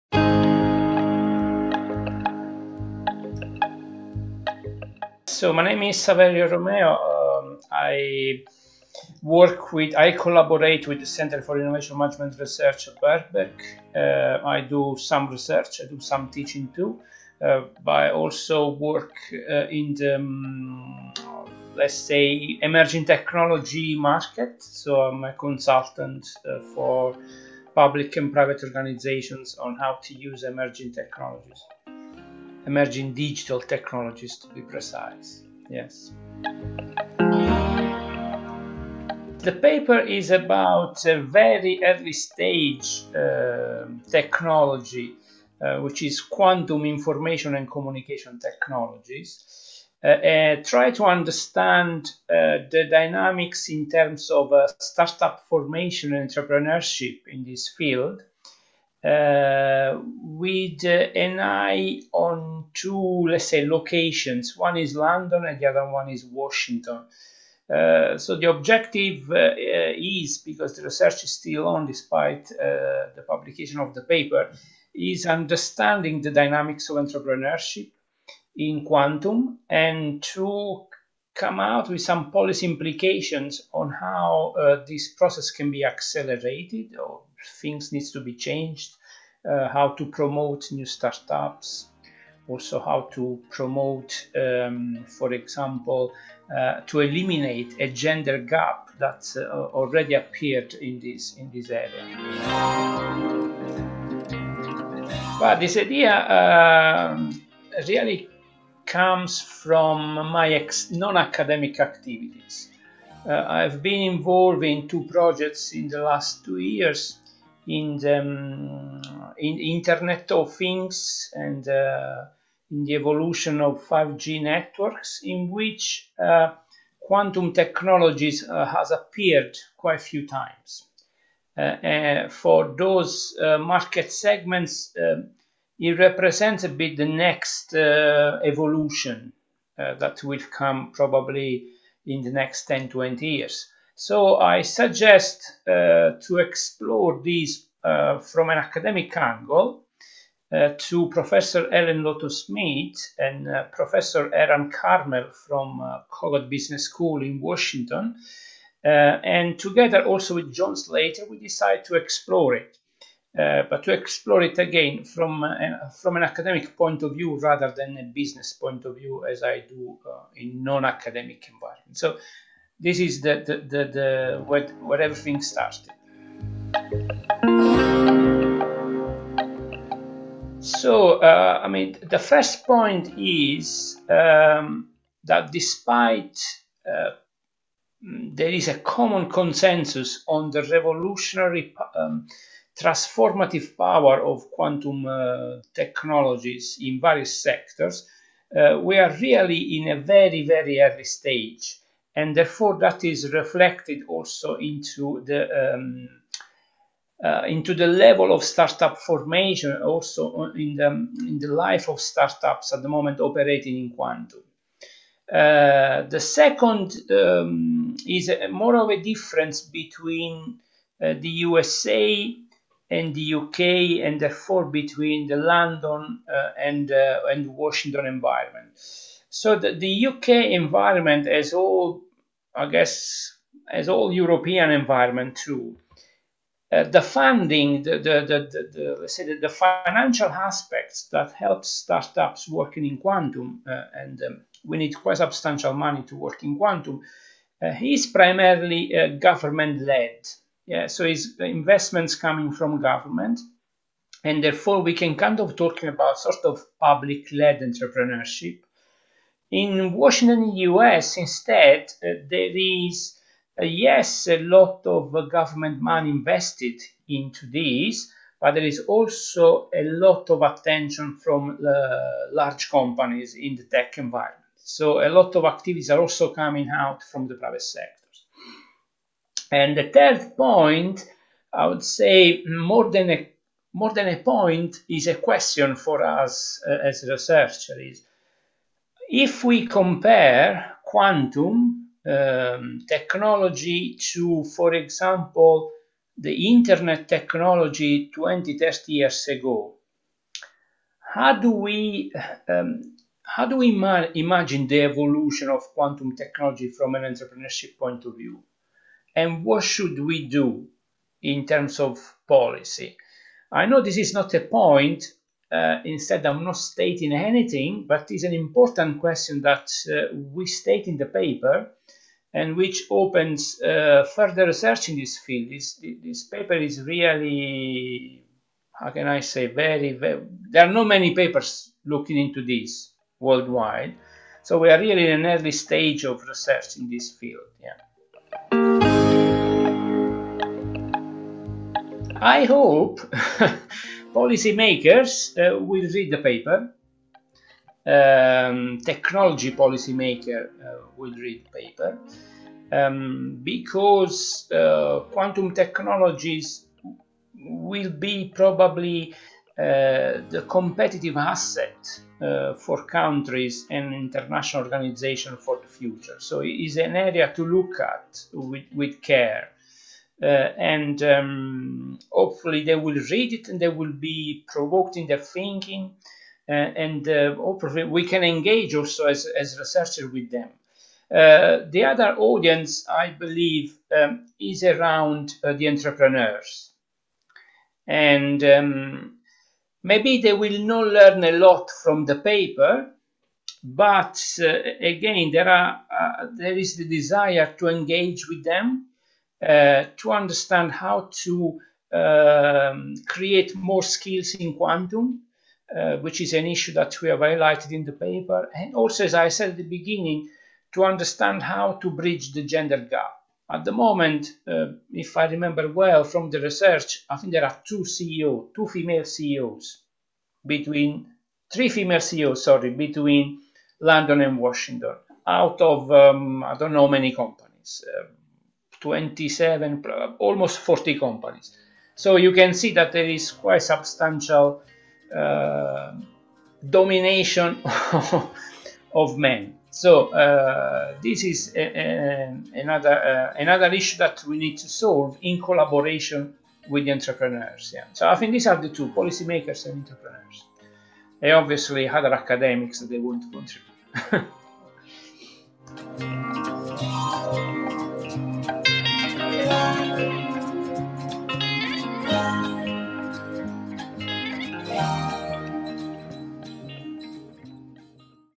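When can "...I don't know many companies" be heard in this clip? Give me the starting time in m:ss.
7:06.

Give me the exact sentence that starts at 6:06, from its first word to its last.
So it is an area to look at with, with care.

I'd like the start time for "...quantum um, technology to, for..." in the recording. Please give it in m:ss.
4:50.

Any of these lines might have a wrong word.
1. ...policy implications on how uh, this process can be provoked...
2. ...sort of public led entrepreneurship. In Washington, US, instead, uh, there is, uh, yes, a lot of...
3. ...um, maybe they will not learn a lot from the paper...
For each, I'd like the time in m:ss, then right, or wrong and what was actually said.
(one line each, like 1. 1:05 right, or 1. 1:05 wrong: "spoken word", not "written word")
1. 1:22 wrong: "accelerated", not "provoked"
2. 4:16 right
3. 6:28 right.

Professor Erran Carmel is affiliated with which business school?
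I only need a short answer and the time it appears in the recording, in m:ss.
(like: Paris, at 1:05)
Kogod Business School, at 2:36.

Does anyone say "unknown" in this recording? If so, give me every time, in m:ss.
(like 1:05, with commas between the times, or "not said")
not said.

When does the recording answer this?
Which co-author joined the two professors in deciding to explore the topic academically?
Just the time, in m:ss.
2:40.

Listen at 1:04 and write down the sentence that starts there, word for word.
One is London and the other one is Washington.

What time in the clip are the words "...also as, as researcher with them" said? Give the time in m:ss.
6:18.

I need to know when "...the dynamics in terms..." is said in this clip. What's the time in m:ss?
0:52.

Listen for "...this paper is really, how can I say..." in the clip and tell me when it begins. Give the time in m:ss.
5:26.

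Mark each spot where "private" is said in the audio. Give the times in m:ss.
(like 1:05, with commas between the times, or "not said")
0:28, 4:37.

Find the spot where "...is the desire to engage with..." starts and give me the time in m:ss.
6:36.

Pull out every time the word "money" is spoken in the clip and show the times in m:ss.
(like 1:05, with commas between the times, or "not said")
4:05, 4:25.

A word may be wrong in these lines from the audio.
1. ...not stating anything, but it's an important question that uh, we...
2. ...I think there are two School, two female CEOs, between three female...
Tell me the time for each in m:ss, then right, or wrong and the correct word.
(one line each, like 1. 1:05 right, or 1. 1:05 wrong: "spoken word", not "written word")
1. 5:16 right
2. 6:57 wrong: "CEOs", not "School".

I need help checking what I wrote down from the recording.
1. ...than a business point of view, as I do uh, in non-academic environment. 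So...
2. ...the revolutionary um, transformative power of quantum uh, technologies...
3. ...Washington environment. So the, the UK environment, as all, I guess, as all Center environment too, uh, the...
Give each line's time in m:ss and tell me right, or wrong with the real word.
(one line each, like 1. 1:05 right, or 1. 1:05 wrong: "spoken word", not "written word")
1. 2:47 right
2. 3:10 right
3. 3:47 wrong: "European", not "Center".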